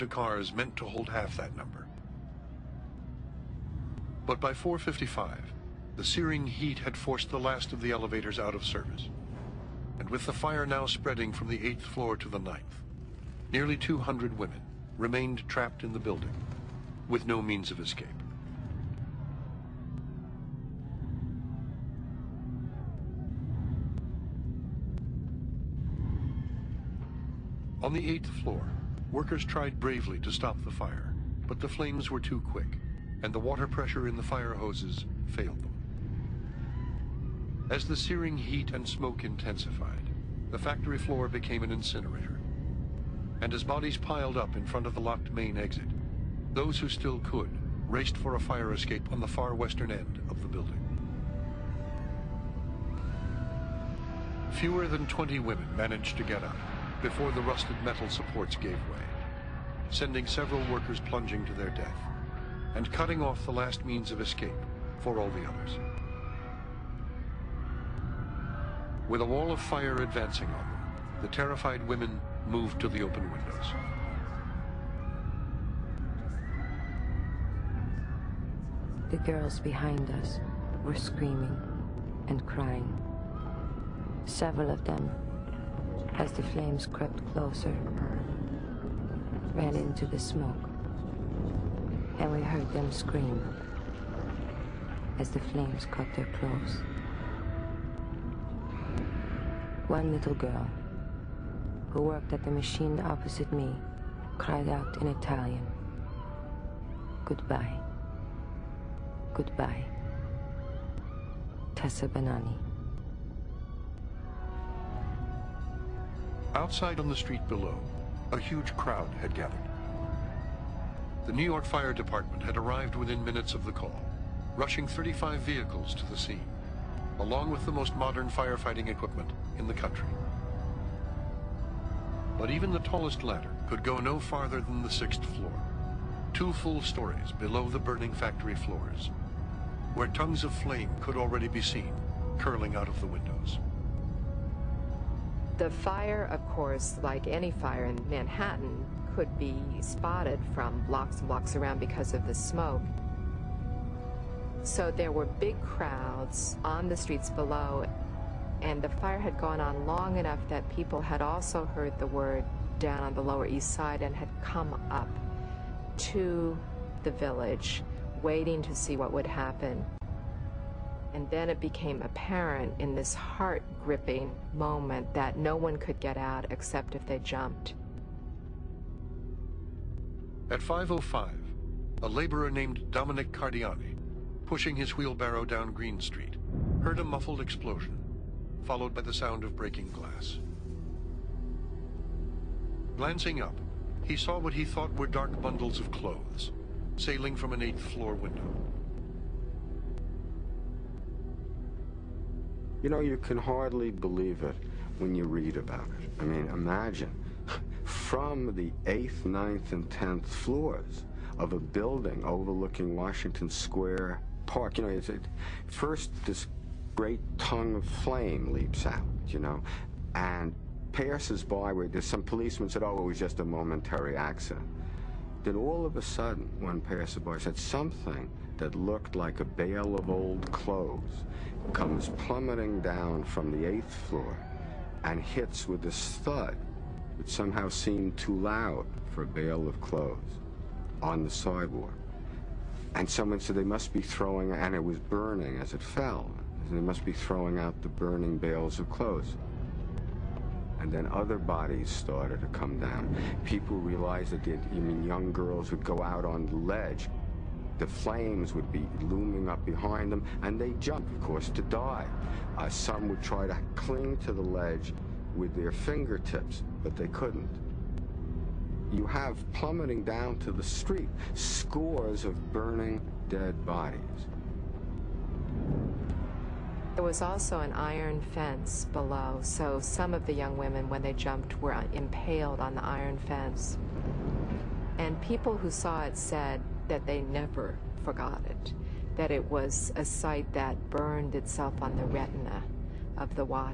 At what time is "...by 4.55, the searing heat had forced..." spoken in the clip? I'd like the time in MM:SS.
00:04.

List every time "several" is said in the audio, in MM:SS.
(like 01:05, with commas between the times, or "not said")
01:00, 01:24.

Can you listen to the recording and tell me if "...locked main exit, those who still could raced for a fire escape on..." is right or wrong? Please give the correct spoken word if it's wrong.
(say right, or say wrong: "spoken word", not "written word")
right.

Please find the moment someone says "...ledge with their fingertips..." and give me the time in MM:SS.
04:24.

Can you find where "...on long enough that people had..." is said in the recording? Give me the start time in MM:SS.
02:39.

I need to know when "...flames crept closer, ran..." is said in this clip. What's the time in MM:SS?
01:26.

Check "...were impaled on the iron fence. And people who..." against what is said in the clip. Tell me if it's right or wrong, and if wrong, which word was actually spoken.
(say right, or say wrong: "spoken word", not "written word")
right.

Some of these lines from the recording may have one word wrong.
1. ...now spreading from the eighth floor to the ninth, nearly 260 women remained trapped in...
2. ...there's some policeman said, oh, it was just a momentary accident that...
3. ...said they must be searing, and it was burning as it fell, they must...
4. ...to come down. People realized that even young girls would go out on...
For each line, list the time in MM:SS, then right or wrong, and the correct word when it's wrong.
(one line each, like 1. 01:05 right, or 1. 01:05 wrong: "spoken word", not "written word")
1. 00:10 wrong: "200", not "260"
2. 03:41 right
3. 04:03 wrong: "throwing", not "searing"
4. 04:12 right.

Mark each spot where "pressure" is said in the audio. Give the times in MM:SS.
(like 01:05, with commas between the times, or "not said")
00:33.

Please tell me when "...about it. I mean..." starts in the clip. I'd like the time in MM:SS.
03:25.